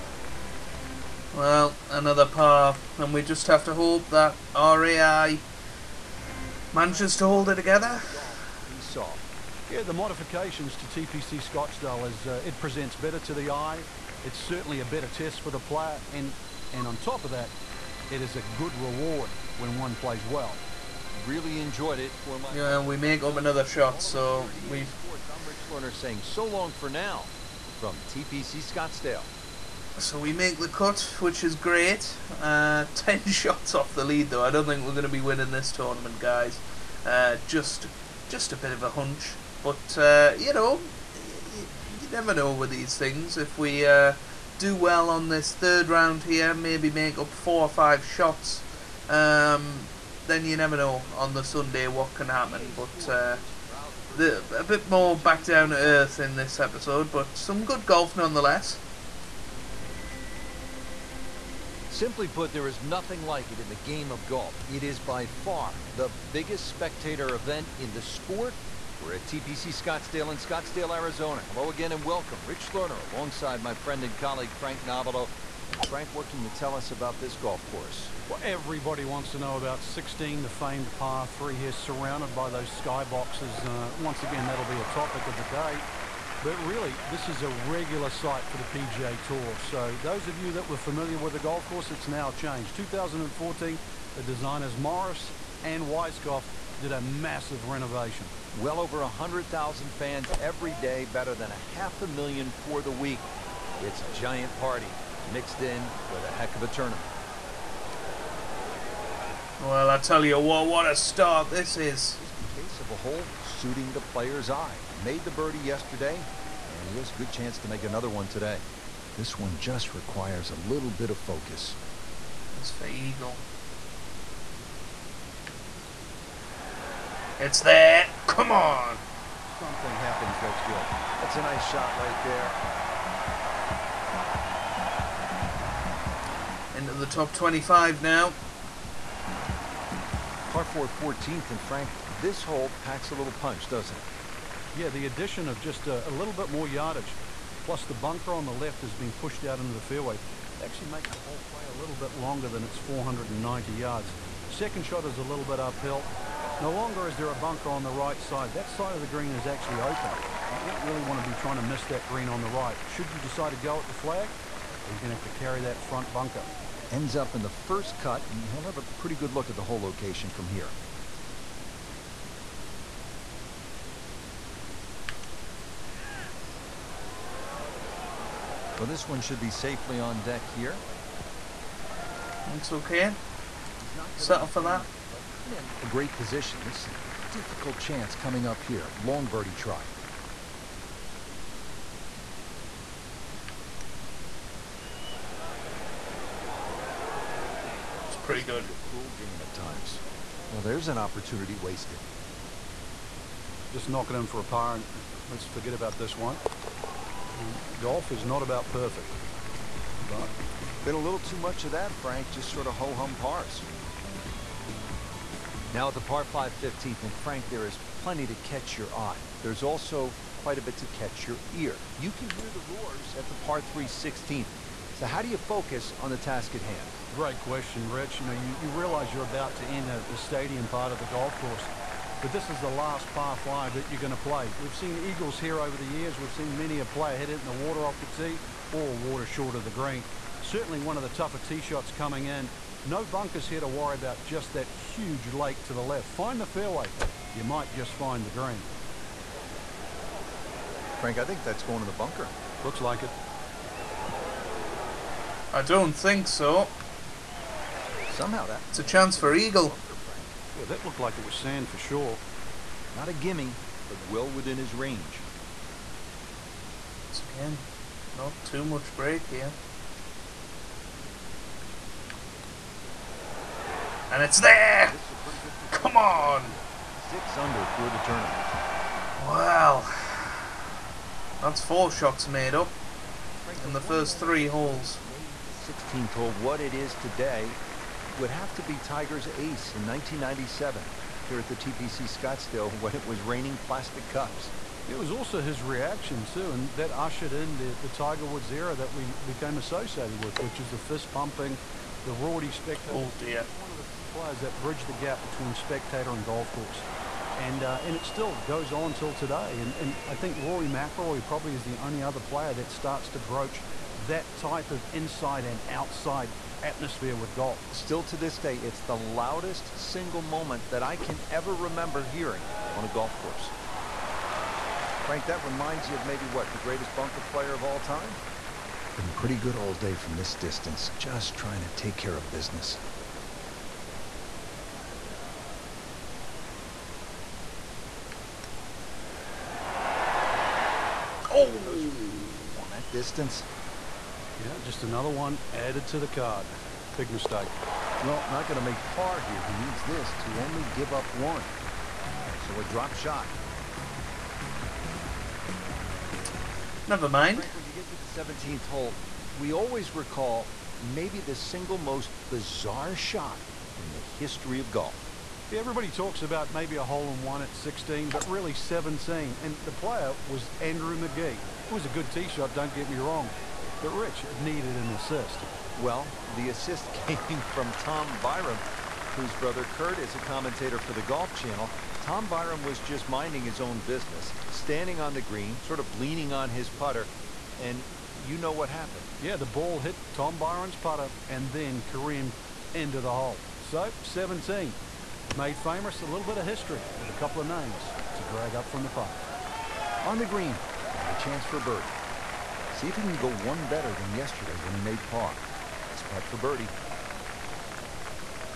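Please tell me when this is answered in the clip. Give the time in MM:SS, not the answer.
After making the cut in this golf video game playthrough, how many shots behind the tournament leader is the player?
00:32.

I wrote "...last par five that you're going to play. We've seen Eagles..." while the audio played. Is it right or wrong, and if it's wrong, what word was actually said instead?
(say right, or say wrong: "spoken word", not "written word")
right.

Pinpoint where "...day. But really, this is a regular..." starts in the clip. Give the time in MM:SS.
01:25.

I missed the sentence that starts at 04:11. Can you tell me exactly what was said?
Frank, I think that's going to the bunker.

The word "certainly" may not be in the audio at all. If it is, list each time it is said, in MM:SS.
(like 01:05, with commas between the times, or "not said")
00:14, 04:00.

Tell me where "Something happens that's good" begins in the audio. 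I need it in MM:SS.
02:09.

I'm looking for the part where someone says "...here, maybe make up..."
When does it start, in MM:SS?
00:46.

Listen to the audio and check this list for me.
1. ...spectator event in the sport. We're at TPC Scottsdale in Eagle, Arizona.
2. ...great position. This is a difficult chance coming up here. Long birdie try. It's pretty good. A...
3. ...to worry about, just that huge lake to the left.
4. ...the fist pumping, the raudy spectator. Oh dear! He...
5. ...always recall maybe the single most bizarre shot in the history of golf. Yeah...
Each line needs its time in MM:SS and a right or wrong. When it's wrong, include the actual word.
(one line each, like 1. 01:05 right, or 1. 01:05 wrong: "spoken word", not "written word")
1. 01:06 wrong: "Scottsdale", not "Eagle"
2. 03:05 right
3. 04:03 right
4. 05:00 right
5. 05:59 right.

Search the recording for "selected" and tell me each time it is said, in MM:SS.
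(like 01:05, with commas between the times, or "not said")
not said.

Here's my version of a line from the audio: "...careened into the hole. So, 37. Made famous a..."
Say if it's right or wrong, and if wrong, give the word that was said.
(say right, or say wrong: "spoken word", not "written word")
wrong: "17", not "37".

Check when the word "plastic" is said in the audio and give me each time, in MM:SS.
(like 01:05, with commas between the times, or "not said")
04:53.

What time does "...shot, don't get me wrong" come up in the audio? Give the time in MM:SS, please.
06:12.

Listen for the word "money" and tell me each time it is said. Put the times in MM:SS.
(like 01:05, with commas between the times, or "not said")
not said.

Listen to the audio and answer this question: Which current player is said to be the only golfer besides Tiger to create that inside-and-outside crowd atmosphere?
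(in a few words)
Rory McIlroy.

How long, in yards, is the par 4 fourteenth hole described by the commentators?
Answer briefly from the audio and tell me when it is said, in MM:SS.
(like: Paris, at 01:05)
490 yards, at 02:32.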